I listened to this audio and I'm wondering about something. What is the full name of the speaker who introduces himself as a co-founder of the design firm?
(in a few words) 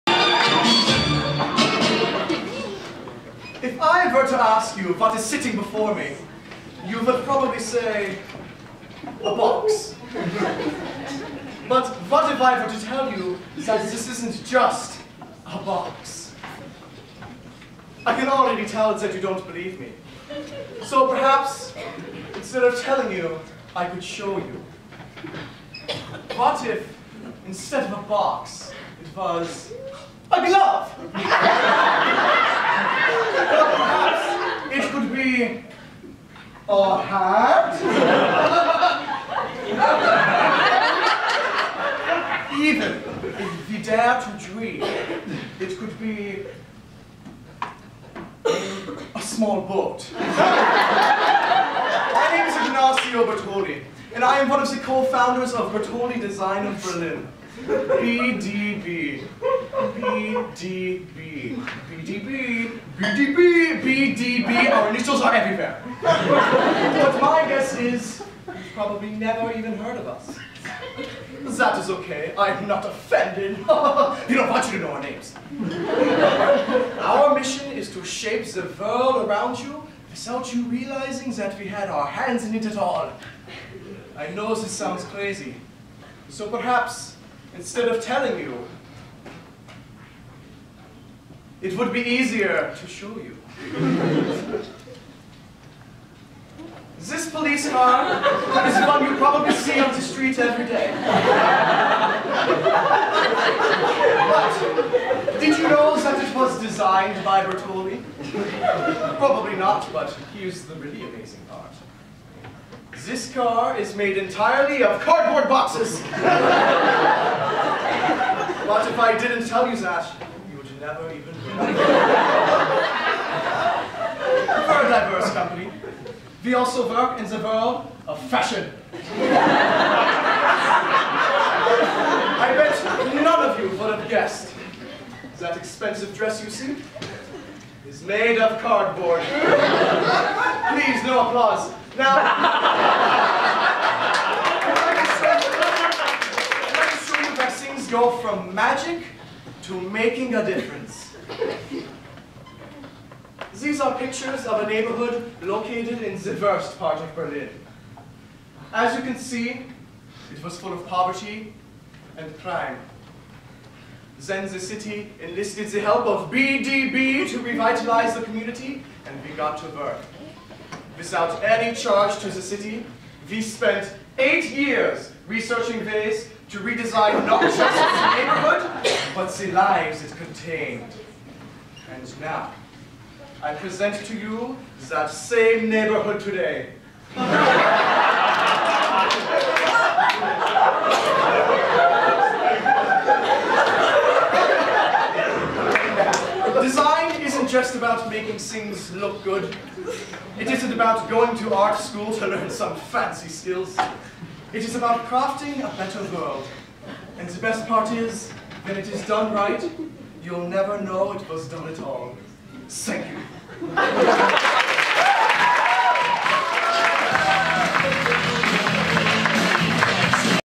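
Ignacio Bertoli.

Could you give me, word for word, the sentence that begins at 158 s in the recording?
As you can see, it was full of poverty and crime.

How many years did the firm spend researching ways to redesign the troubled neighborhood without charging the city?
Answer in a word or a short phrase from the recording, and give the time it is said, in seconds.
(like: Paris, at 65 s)
8, at 174 s.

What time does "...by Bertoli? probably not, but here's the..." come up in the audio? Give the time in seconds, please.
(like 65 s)
107 s.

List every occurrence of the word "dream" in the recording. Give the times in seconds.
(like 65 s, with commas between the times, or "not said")
44 s.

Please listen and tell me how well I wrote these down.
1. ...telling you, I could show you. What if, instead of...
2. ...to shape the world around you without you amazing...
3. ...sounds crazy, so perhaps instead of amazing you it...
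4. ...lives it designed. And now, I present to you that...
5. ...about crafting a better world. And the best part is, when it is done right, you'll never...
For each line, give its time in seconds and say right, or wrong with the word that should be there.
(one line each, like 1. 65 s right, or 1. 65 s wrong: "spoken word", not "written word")
1. 22 s right
2. 77 s wrong: "realizing", not "amazing"
3. 84 s wrong: "telling", not "amazing"
4. 179 s wrong: "contained", not "designed"
5. 204 s right.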